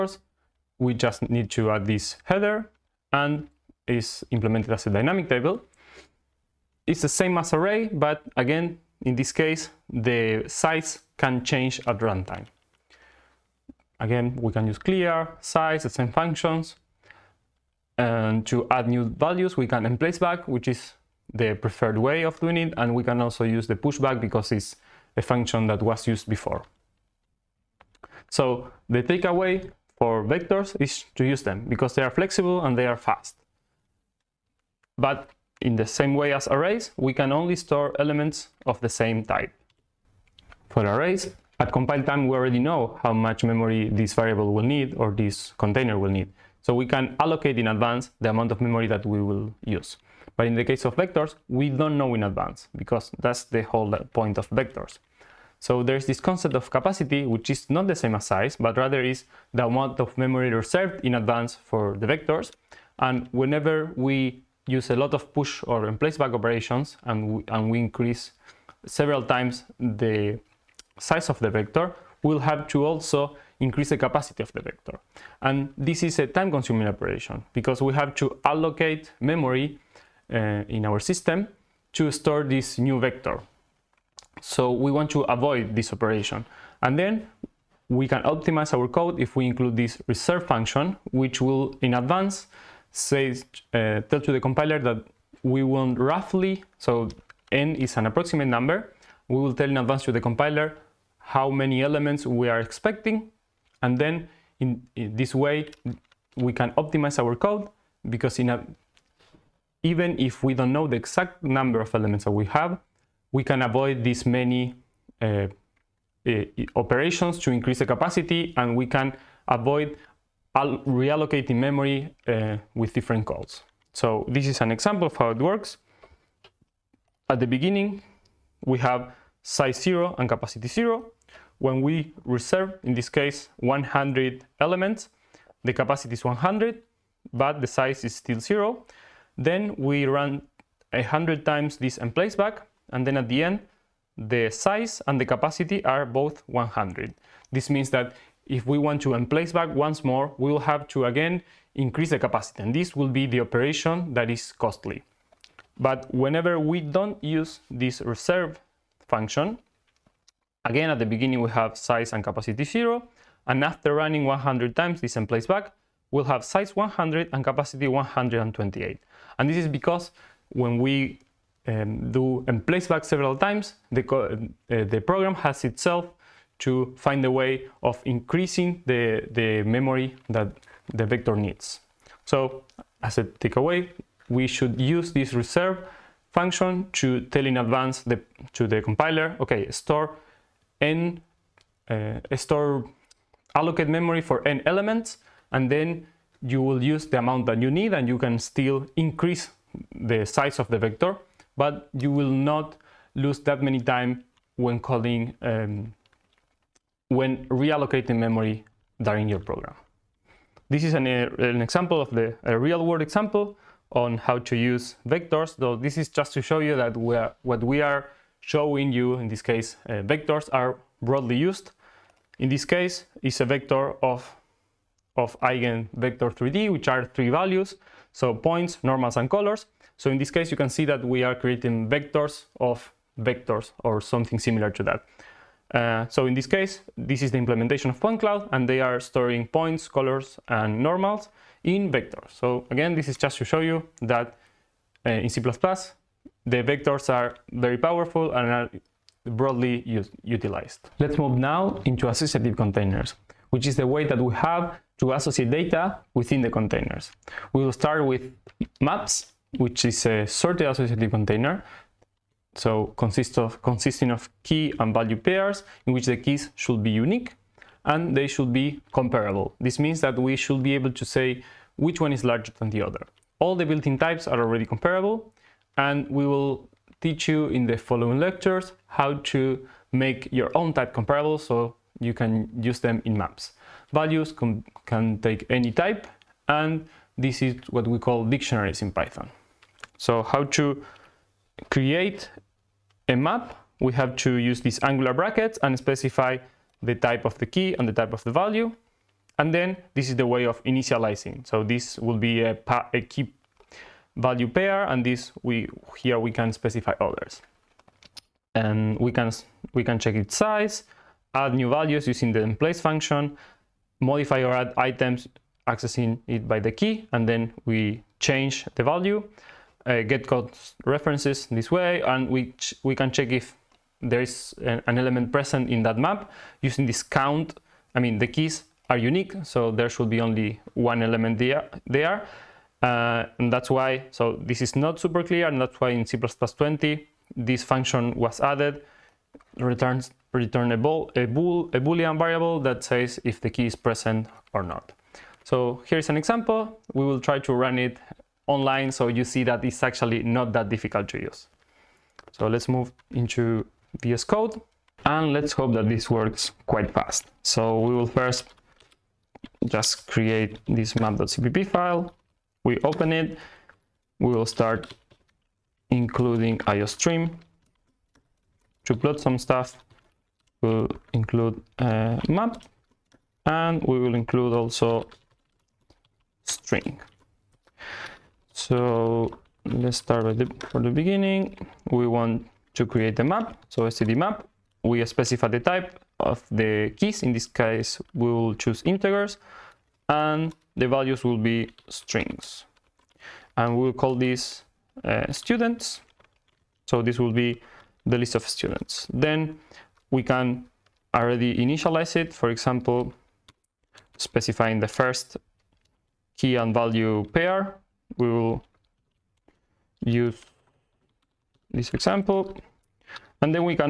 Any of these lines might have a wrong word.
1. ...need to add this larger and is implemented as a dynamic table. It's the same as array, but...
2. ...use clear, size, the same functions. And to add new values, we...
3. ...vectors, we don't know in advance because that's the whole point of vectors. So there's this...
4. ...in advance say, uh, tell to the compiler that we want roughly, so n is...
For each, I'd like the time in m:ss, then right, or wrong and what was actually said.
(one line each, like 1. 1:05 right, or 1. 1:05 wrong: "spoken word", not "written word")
1. 0:01 wrong: "header", not "larger"
2. 0:14 right
3. 0:50 right
4. 1:31 right.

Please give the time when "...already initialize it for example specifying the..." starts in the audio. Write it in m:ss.
6:41.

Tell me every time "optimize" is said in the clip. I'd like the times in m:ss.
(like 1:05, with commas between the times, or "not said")
1:28, 1:46.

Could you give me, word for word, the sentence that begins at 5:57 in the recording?
So we will first just create this map.cpp file.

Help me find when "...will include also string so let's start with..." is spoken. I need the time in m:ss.
6:13.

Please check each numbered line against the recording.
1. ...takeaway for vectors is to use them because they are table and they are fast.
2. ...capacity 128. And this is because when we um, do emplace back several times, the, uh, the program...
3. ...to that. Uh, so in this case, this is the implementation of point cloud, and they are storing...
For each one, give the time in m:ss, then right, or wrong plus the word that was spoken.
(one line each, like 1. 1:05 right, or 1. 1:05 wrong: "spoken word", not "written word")
1. 0:29 wrong: "flexible", not "table"
2. 2:47 right
3. 3:54 right.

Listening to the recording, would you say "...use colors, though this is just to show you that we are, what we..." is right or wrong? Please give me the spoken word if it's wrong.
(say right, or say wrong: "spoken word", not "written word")
wrong: "vectors", not "colors".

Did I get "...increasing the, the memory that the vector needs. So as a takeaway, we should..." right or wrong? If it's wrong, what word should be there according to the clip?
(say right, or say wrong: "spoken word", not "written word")
right.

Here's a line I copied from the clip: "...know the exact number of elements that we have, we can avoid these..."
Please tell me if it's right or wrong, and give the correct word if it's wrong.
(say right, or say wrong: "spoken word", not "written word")
right.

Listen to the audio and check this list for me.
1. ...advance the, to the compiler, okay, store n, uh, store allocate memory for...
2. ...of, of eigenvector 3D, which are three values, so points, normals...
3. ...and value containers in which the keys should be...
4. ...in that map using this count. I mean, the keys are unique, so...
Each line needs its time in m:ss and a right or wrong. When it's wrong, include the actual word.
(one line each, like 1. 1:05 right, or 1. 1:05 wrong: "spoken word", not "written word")
1. 3:07 right
2. 3:44 right
3. 4:24 wrong: "pairs", not "containers"
4. 5:25 right.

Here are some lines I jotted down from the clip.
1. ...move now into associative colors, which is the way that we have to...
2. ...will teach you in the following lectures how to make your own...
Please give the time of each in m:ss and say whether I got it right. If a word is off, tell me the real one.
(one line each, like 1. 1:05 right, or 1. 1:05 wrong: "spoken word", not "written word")
1. 4:11 wrong: "containers", not "colors"
2. 4:36 right.